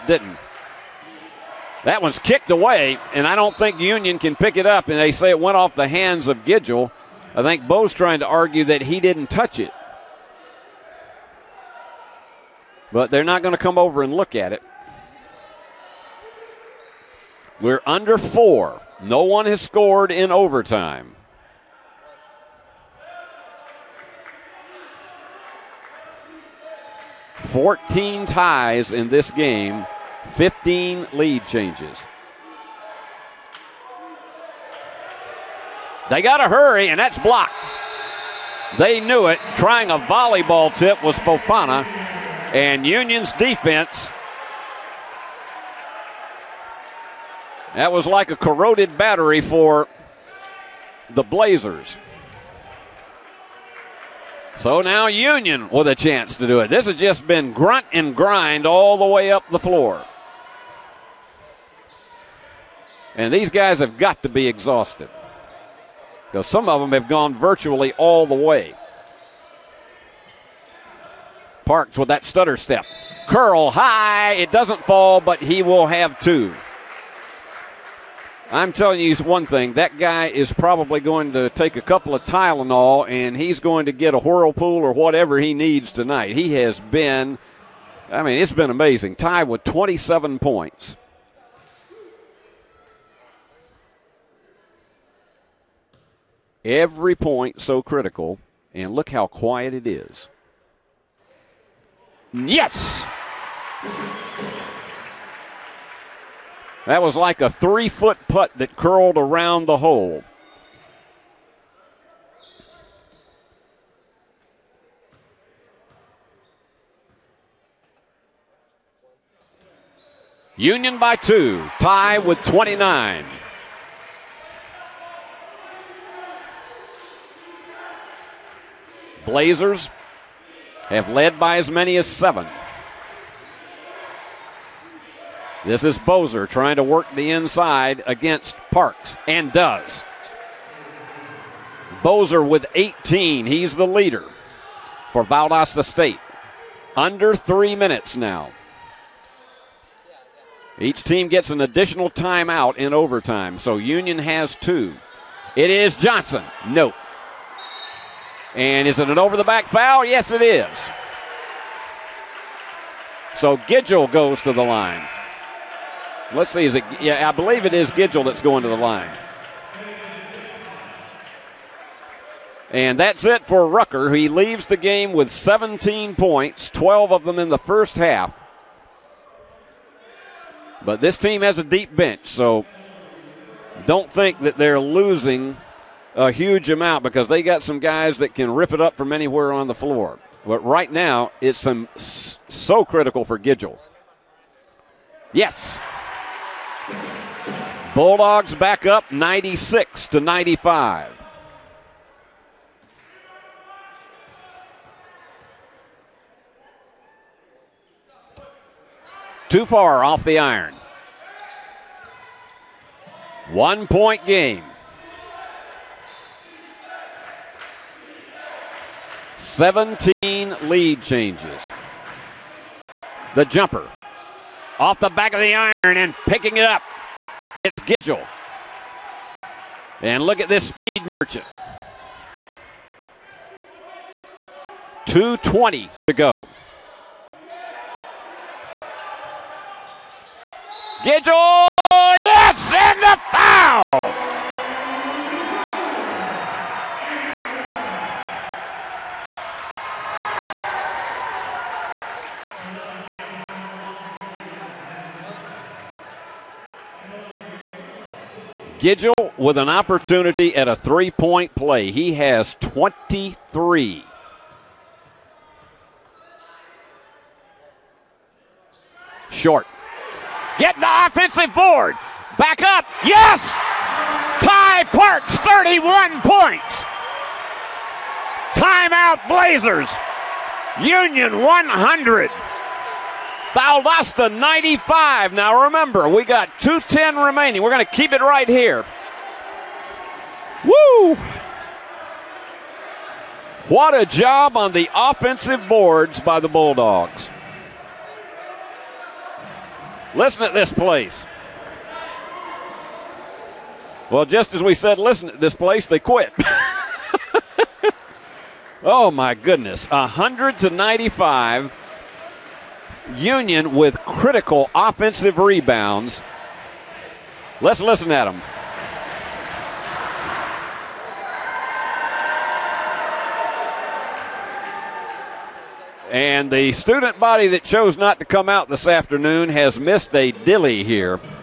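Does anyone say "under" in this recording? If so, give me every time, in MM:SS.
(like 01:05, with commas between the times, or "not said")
00:17, 02:26.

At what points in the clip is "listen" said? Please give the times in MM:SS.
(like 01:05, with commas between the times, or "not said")
05:00, 05:04, 05:17.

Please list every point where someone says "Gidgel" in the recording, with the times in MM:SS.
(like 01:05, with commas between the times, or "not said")
00:06, 02:43, 02:47, 03:13, 03:47, 04:01, 04:18.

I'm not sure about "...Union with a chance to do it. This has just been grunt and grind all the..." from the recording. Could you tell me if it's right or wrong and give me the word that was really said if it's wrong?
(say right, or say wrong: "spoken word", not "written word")
right.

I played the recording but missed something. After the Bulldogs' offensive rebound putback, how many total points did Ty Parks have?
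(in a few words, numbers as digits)
31.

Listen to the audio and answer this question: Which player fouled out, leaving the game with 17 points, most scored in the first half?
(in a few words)
Rucker.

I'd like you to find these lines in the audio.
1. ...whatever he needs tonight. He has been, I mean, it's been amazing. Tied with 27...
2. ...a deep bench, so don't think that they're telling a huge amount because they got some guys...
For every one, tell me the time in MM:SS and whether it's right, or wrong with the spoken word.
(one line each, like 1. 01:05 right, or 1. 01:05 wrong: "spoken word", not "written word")
1. 01:24 right
2. 03:01 wrong: "losing", not "telling".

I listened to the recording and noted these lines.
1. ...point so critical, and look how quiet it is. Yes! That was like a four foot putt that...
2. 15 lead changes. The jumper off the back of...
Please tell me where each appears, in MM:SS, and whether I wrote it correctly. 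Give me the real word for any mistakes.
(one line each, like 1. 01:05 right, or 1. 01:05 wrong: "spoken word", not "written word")
1. 01:37 wrong: "three", not "four"
2. 03:39 wrong: "17", not "15".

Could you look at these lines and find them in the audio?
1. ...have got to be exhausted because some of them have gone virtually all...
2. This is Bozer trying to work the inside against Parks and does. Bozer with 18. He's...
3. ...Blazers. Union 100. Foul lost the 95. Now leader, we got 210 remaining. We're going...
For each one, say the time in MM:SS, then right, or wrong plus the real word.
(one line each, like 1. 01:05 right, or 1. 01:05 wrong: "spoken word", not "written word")
1. 01:03 right
2. 02:15 right
3. 04:39 wrong: "remember", not "leader".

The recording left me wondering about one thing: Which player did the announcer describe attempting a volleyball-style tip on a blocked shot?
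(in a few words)
Fofana.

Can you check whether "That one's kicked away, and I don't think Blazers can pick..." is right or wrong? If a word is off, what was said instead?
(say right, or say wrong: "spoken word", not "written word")
wrong: "Union", not "Blazers".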